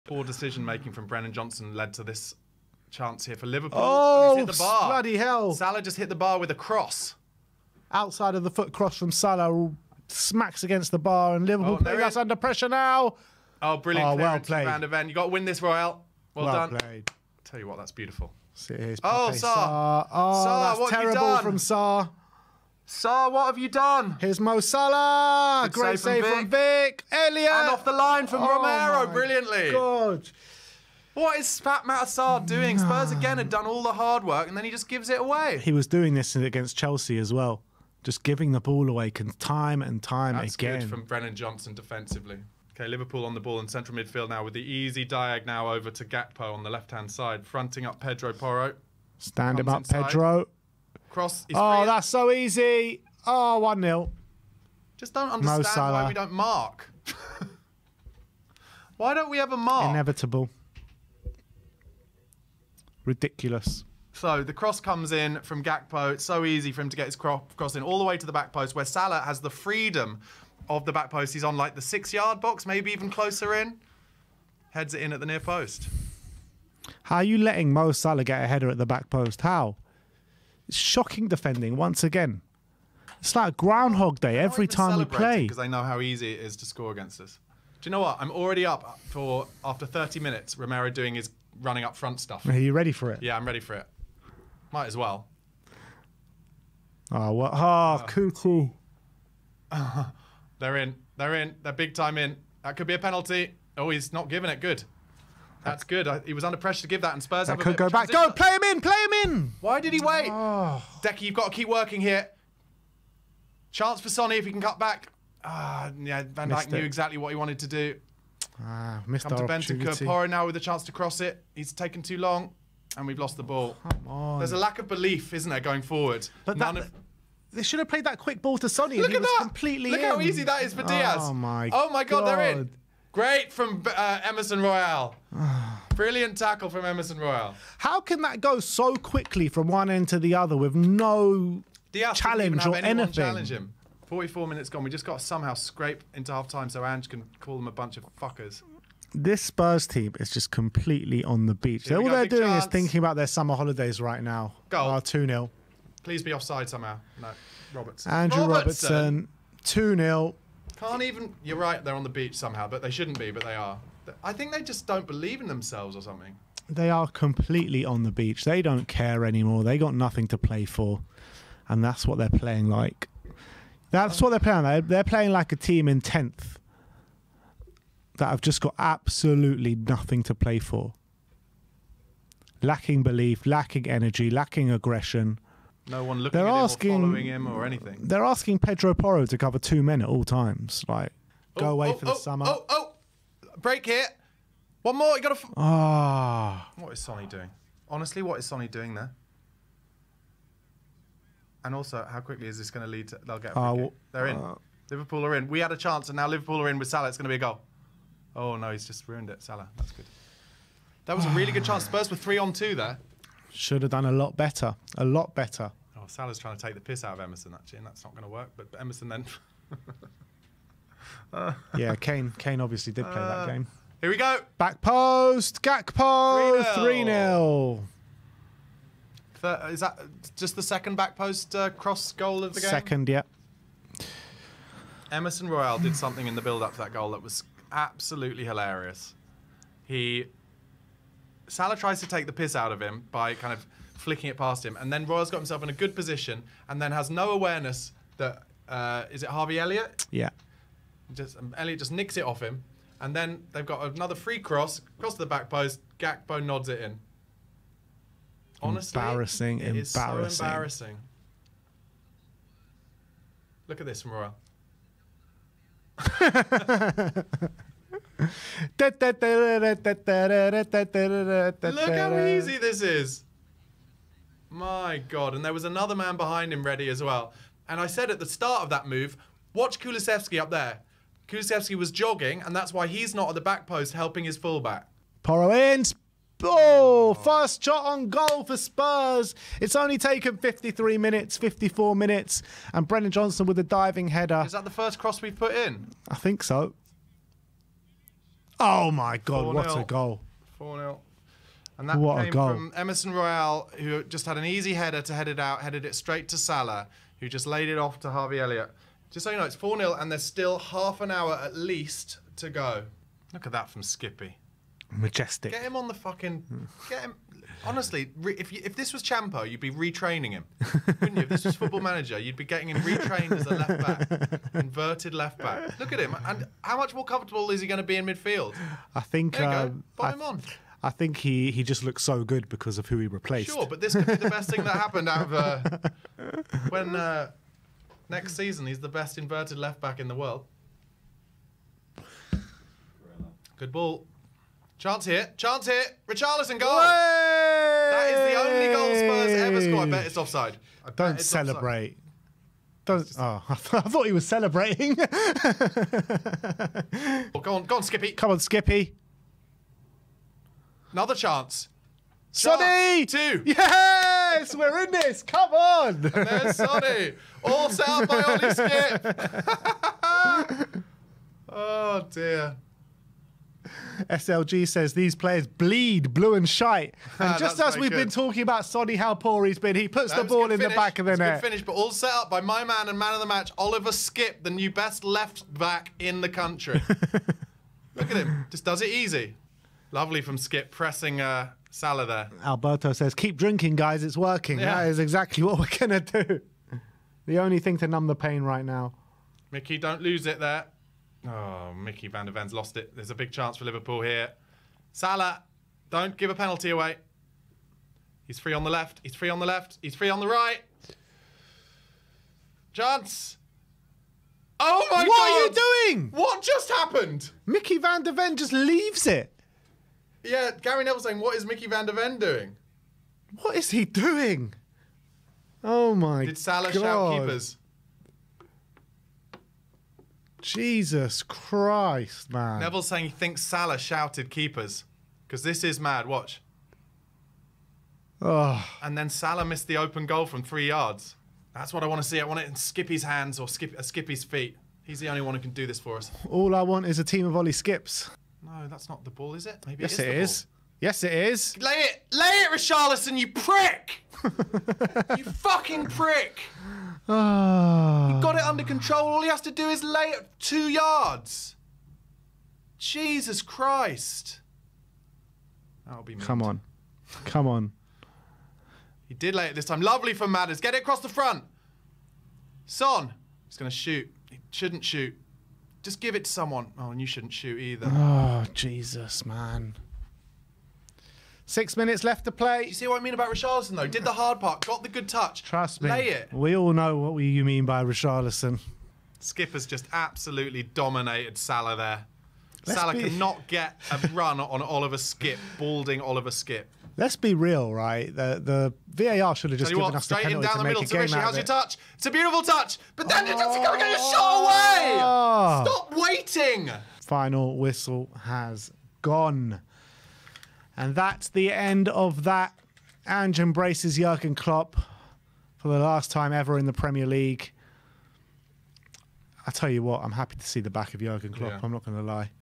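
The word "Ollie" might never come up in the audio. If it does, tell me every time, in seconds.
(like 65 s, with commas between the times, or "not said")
368 s, 447 s.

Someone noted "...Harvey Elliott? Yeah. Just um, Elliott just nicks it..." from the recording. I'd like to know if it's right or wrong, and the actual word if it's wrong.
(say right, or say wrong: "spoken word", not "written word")
right.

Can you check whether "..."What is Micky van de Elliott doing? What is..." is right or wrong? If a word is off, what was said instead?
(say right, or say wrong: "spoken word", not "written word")
wrong: "Ven", not "Elliott".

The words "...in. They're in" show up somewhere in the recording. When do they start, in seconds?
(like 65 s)
100 s.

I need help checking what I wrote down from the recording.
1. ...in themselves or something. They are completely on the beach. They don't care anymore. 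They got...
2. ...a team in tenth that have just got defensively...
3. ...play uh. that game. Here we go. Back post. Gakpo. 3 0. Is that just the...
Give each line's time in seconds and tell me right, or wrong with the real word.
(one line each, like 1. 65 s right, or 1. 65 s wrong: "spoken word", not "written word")
1. 165 s right
2. 175 s wrong: "absolutely", not "defensively"
3. 223 s right.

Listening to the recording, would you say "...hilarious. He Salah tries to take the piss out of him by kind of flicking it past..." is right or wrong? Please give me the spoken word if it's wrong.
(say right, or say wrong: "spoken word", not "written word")
right.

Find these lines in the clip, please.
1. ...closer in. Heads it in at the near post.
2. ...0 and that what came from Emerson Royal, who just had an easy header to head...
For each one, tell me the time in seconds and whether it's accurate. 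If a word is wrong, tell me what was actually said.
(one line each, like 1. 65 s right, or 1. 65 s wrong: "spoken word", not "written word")
1. 73 s right
2. 300 s right.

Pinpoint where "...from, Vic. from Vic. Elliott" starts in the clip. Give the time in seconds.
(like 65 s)
26 s.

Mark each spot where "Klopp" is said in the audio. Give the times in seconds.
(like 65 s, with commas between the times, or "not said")
514 s, 521 s.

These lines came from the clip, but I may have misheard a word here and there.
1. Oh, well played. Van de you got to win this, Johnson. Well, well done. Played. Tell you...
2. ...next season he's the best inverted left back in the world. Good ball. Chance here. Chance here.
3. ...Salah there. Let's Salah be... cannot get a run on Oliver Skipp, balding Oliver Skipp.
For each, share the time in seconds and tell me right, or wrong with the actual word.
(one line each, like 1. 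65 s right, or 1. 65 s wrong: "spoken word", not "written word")
1. 14 s wrong: "Royal", not "Johnson"
2. 338 s right
3. 491 s right.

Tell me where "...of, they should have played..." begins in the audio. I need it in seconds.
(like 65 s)
126 s.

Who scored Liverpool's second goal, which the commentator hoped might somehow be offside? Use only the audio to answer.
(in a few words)
Andrew Robertson.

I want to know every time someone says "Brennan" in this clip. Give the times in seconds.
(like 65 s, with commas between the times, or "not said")
1 s, 41 s, 292 s.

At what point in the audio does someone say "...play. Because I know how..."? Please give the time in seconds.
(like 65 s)
85 s.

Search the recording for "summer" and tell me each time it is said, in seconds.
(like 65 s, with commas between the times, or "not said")
153 s, 192 s.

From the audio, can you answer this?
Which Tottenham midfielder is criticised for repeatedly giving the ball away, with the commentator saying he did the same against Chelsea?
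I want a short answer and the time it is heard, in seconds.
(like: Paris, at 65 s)
Pape Matar Sarr, at 31 s.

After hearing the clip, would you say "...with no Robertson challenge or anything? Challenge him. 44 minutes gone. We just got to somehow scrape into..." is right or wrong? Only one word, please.
wrong.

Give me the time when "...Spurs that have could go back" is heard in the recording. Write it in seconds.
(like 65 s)
107 s.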